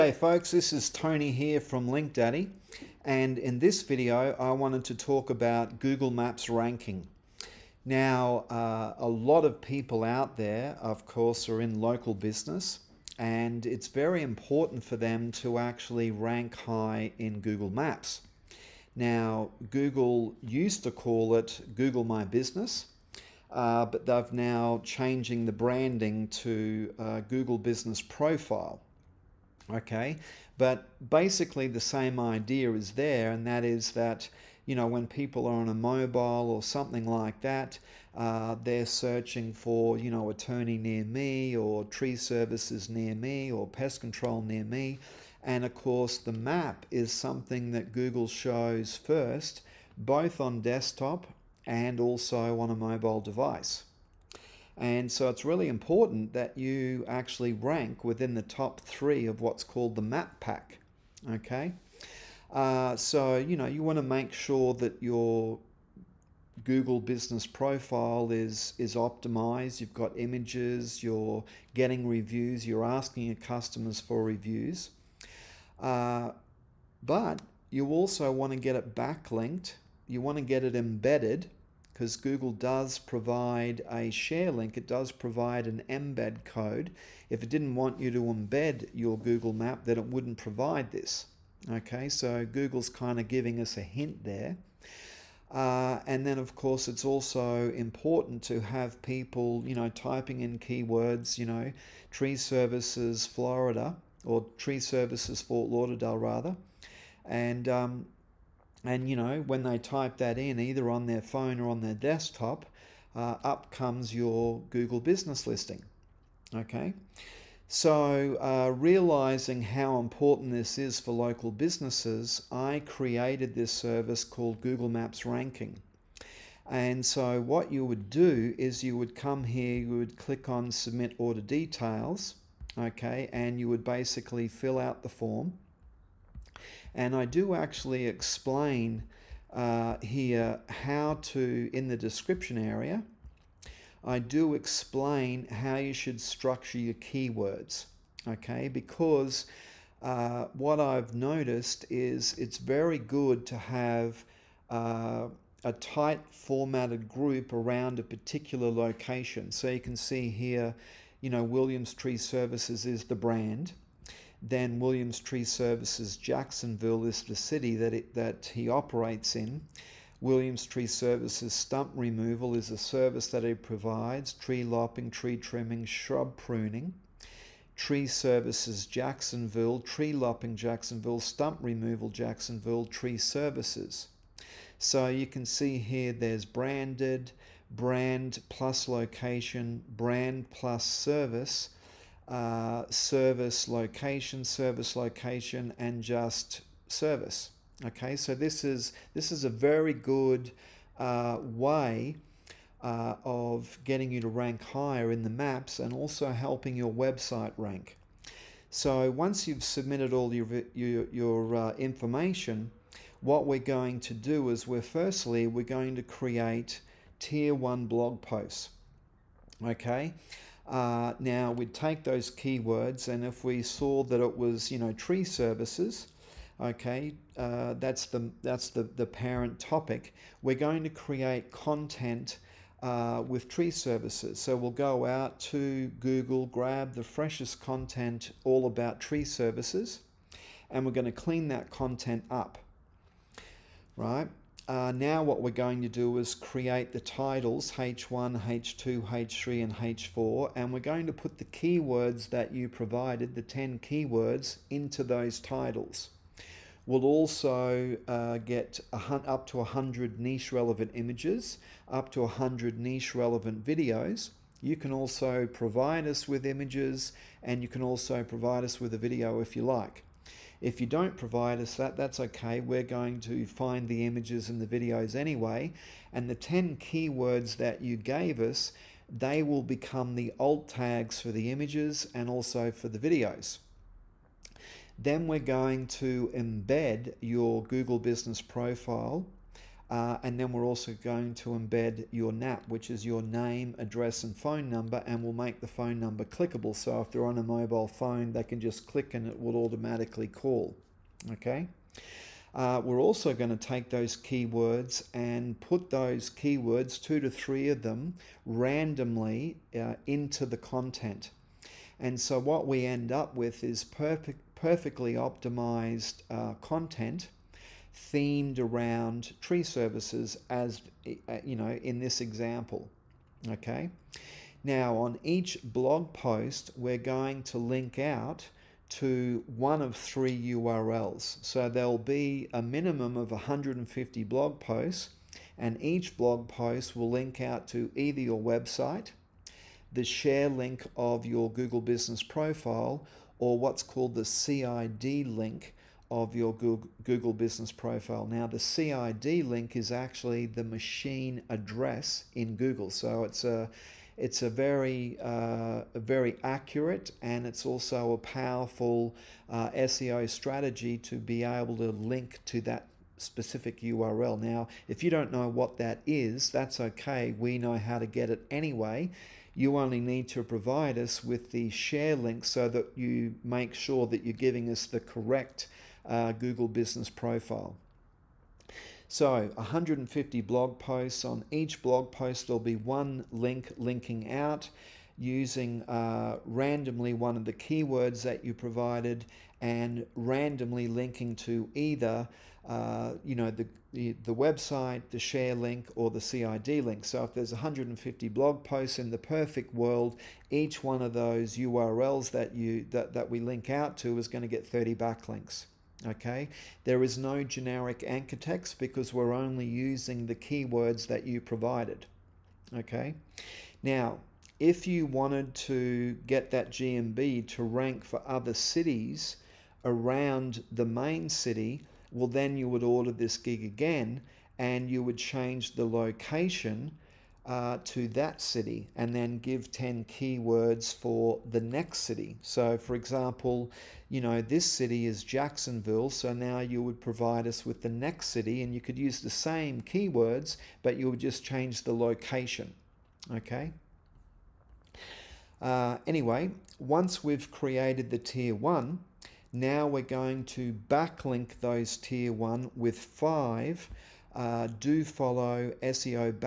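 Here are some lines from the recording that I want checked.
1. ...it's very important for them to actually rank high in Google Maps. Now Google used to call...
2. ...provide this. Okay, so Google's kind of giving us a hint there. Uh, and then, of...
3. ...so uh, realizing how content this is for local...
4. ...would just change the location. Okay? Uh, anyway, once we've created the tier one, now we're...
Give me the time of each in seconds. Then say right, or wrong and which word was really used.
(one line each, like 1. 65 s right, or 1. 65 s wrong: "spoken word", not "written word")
1. 13 s right
2. 90 s right
3. 117 s wrong: "important", not "content"
4. 441 s right.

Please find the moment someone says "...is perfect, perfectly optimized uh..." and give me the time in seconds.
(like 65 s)
313 s.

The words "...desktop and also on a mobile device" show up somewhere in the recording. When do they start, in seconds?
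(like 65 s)
50 s.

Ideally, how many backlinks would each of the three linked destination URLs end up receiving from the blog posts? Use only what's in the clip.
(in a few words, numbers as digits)
30.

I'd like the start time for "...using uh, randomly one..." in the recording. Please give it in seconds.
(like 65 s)
385 s.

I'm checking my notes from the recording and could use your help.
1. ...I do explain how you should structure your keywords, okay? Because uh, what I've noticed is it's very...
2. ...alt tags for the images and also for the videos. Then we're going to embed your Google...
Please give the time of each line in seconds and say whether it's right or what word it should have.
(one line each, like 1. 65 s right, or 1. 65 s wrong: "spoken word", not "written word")
1. 144 s right
2. 280 s right.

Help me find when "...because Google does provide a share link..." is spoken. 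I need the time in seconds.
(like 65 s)
81 s.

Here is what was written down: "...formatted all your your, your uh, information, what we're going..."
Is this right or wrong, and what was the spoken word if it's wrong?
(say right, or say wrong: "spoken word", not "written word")
wrong: "submitted", not "formatted".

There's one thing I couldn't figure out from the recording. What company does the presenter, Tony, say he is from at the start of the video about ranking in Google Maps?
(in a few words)
LinkDaddy.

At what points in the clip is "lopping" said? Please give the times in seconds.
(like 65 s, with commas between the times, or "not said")
174 s, 180 s.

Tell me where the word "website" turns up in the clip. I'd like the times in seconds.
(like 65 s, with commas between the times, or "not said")
206 s, 338 s, 394 s.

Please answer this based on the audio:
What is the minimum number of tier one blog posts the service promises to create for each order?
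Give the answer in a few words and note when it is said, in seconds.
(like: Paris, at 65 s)
150, at 332 s.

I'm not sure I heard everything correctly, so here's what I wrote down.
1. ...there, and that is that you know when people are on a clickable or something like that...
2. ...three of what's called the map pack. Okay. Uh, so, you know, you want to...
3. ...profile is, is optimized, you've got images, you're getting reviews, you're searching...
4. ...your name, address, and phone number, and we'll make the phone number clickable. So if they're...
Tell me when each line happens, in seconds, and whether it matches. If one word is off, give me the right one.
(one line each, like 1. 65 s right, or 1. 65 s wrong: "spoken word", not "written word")
1. 32 s wrong: "mobile", not "clickable"
2. 58 s right
3. 67 s wrong: "asking", not "searching"
4. 293 s right.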